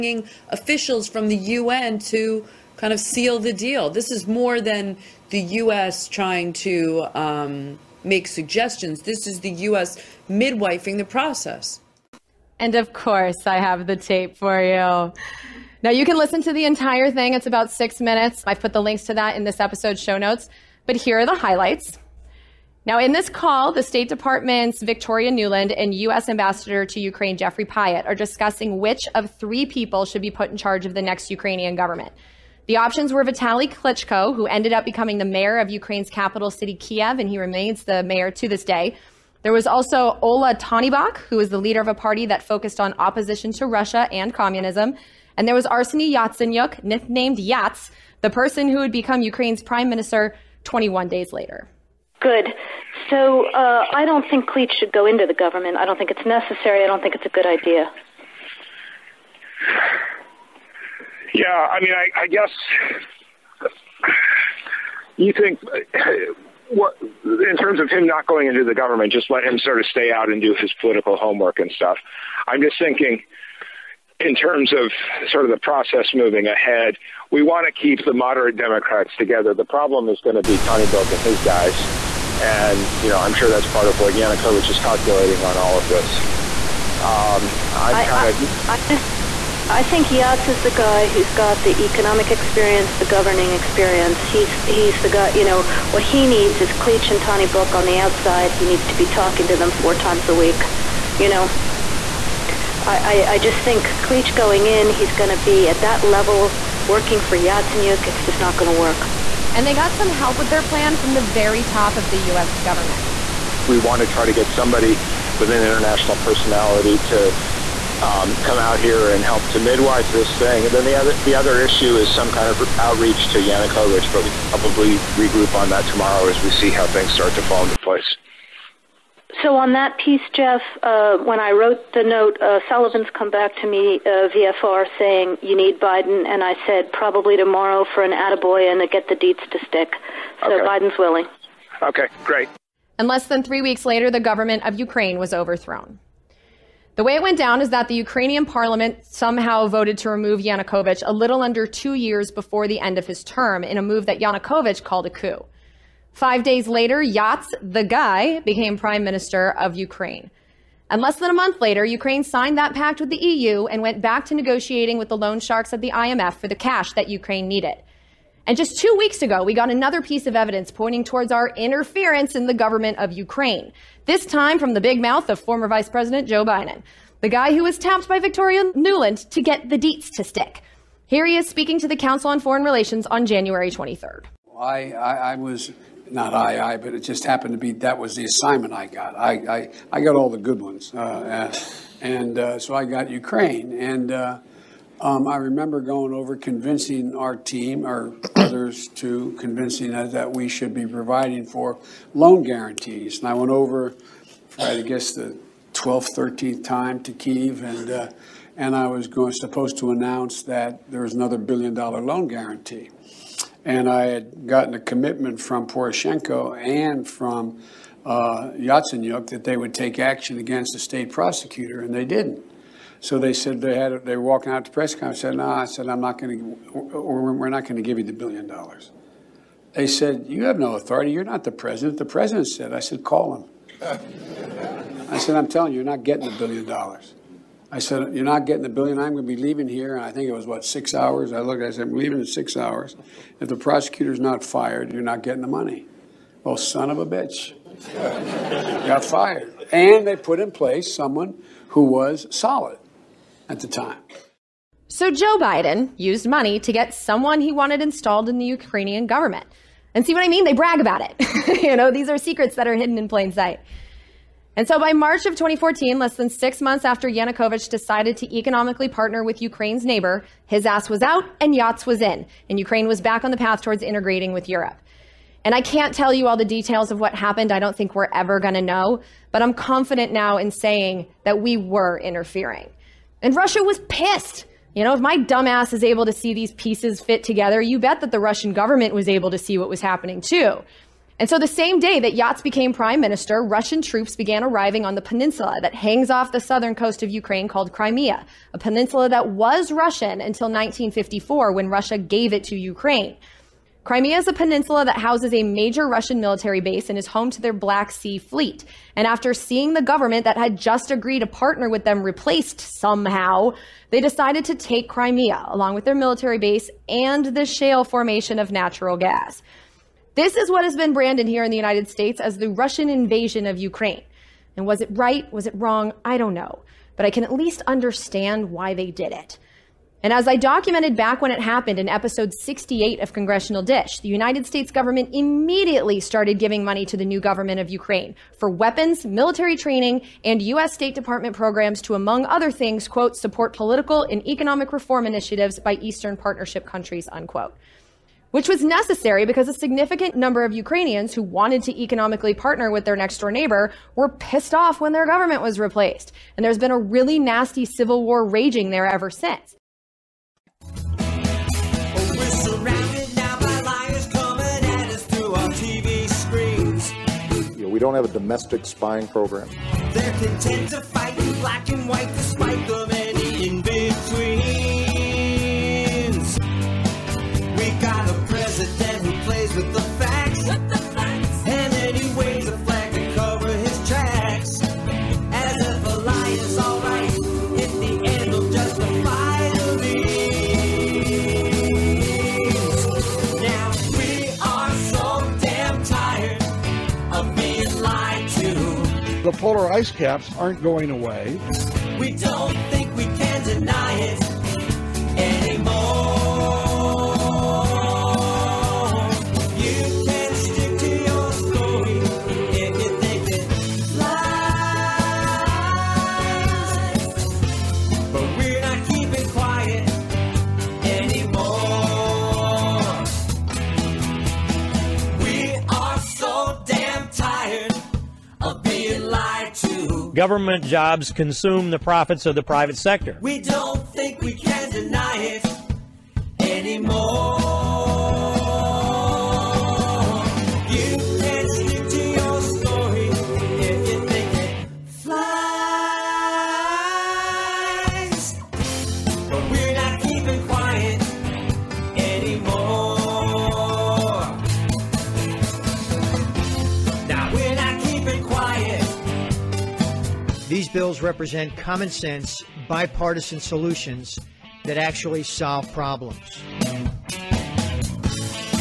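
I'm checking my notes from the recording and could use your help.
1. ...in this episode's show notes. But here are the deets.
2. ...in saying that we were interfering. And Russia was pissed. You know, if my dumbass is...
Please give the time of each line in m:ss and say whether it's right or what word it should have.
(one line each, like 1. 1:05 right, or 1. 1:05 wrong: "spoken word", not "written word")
1. 0:19 wrong: "highlights", not "deets"
2. 4:40 right.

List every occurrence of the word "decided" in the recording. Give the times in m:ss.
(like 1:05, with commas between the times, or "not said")
4:27, 5:13.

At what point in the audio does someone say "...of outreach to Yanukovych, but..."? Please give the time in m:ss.
2:02.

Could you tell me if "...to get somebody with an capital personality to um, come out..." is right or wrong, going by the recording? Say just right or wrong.
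wrong.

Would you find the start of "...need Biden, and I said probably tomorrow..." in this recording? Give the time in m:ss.
2:15.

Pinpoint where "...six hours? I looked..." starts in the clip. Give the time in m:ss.
4:00.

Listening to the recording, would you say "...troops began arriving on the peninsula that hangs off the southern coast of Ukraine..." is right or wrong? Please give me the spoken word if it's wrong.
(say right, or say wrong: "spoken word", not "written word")
right.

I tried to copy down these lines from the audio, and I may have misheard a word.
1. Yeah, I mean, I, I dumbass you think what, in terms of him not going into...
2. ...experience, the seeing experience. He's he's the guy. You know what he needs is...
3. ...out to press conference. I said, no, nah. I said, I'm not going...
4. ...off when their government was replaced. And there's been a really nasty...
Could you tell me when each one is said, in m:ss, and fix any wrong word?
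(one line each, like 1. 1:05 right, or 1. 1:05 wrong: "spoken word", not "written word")
1. 1:01 wrong: "guess", not "dumbass"
2. 1:32 wrong: "governing", not "seeing"
3. 3:44 right
4. 5:54 right.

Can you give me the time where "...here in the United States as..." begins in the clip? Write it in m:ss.
5:21.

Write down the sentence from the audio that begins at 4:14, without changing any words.
So Joe Biden used money to get someone he wanted installed in the Ukrainian government.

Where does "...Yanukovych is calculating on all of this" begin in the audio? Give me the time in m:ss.
1:24.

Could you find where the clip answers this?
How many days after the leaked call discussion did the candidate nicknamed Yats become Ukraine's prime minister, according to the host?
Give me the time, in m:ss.
0:50.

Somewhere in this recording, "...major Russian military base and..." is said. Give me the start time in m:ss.
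5:05.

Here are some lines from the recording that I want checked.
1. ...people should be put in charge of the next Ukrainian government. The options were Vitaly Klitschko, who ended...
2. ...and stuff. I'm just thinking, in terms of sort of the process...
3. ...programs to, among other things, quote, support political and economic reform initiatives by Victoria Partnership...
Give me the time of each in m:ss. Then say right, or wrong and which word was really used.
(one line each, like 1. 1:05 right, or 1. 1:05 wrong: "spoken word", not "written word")
1. 0:29 right
2. 1:11 right
3. 5:41 wrong: "Eastern", not "Victoria".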